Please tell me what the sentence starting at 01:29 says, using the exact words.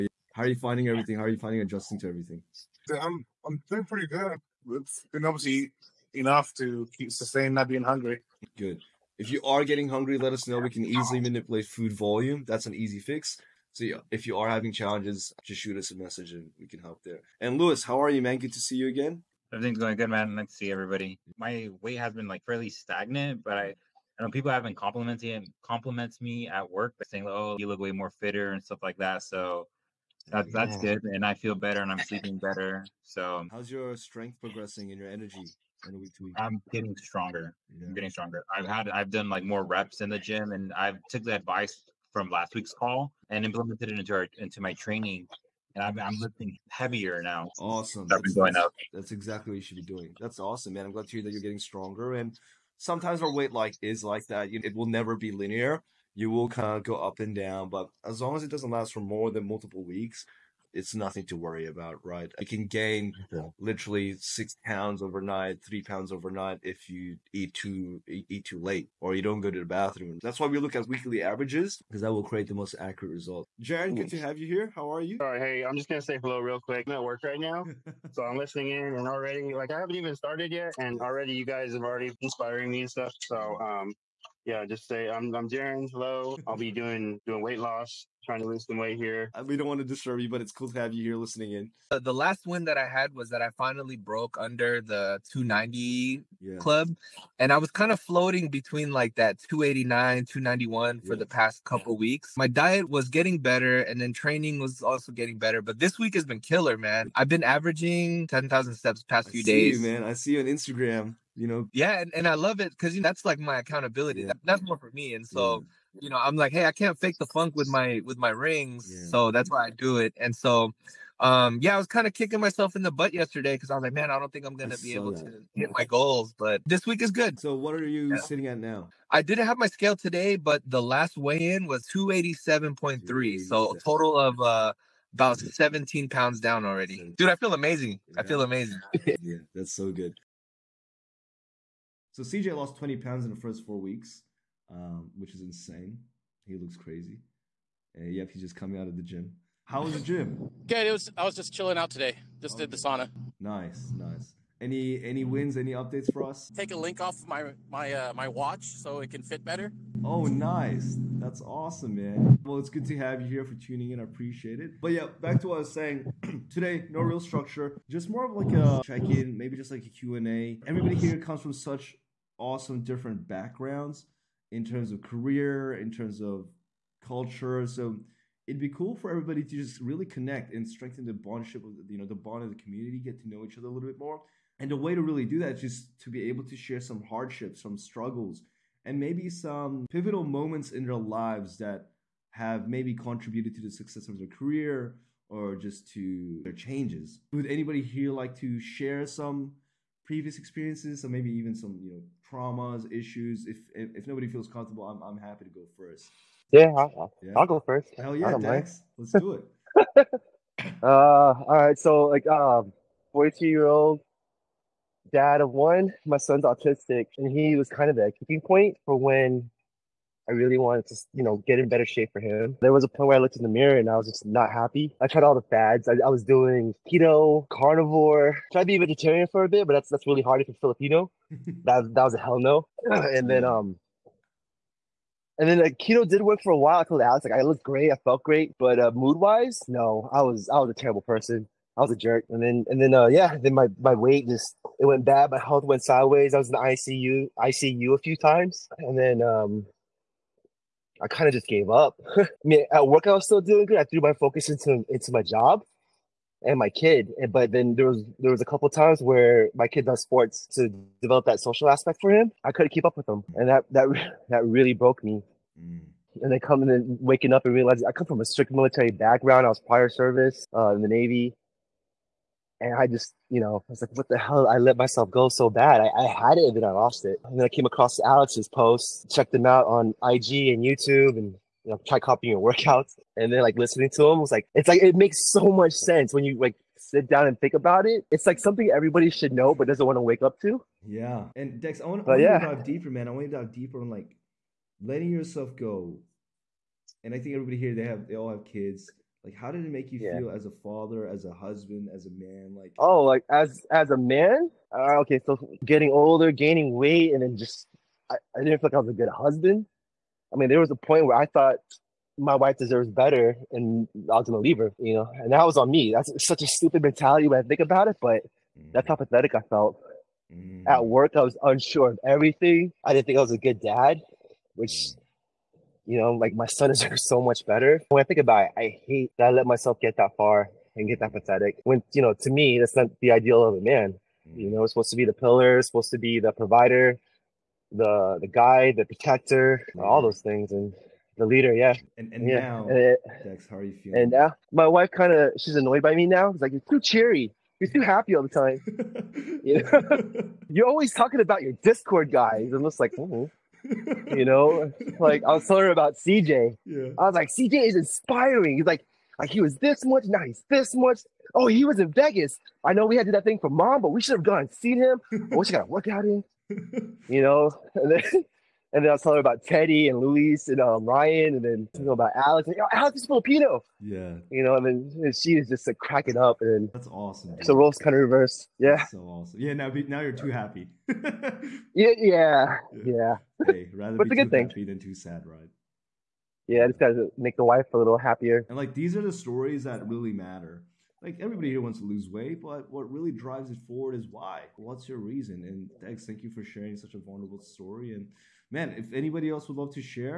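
Uh, we don't want to disturb you, but it's cool to have you here listening in.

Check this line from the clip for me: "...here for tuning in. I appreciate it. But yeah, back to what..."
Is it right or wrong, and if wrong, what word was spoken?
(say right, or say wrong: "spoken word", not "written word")
right.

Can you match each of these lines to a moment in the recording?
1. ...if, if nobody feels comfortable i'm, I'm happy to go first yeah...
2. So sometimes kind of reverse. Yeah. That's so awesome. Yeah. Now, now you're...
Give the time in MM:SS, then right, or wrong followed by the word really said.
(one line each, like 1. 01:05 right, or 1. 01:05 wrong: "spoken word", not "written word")
1. 03:23 right
2. 06:17 wrong: "roles", not "sometimes".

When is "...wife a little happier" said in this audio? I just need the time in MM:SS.
06:27.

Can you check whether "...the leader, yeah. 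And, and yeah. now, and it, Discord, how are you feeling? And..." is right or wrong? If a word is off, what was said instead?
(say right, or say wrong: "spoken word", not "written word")
wrong: "Dex", not "Discord".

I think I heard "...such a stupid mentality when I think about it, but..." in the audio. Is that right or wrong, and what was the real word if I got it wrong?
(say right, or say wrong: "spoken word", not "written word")
right.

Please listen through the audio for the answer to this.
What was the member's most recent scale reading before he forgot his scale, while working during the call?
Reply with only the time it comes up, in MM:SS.
02:11.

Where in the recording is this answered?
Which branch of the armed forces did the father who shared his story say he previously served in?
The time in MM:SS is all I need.
04:30.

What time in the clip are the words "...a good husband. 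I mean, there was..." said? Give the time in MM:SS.
05:08.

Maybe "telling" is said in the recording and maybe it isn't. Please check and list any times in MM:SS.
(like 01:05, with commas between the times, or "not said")
05:55, 06:09.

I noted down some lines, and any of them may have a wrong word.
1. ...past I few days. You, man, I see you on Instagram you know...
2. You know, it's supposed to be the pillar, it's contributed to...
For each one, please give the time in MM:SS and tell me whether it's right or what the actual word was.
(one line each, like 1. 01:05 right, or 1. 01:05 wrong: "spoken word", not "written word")
1. 01:49 right
2. 05:34 wrong: "supposed", not "contributed".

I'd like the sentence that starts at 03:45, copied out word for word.
I, I was doing keto, carnivore, tried to be vegetarian for a bit, but that's that's really hard if you're Filipino.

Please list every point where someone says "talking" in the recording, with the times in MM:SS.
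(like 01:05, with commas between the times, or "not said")
05:50, 06:11.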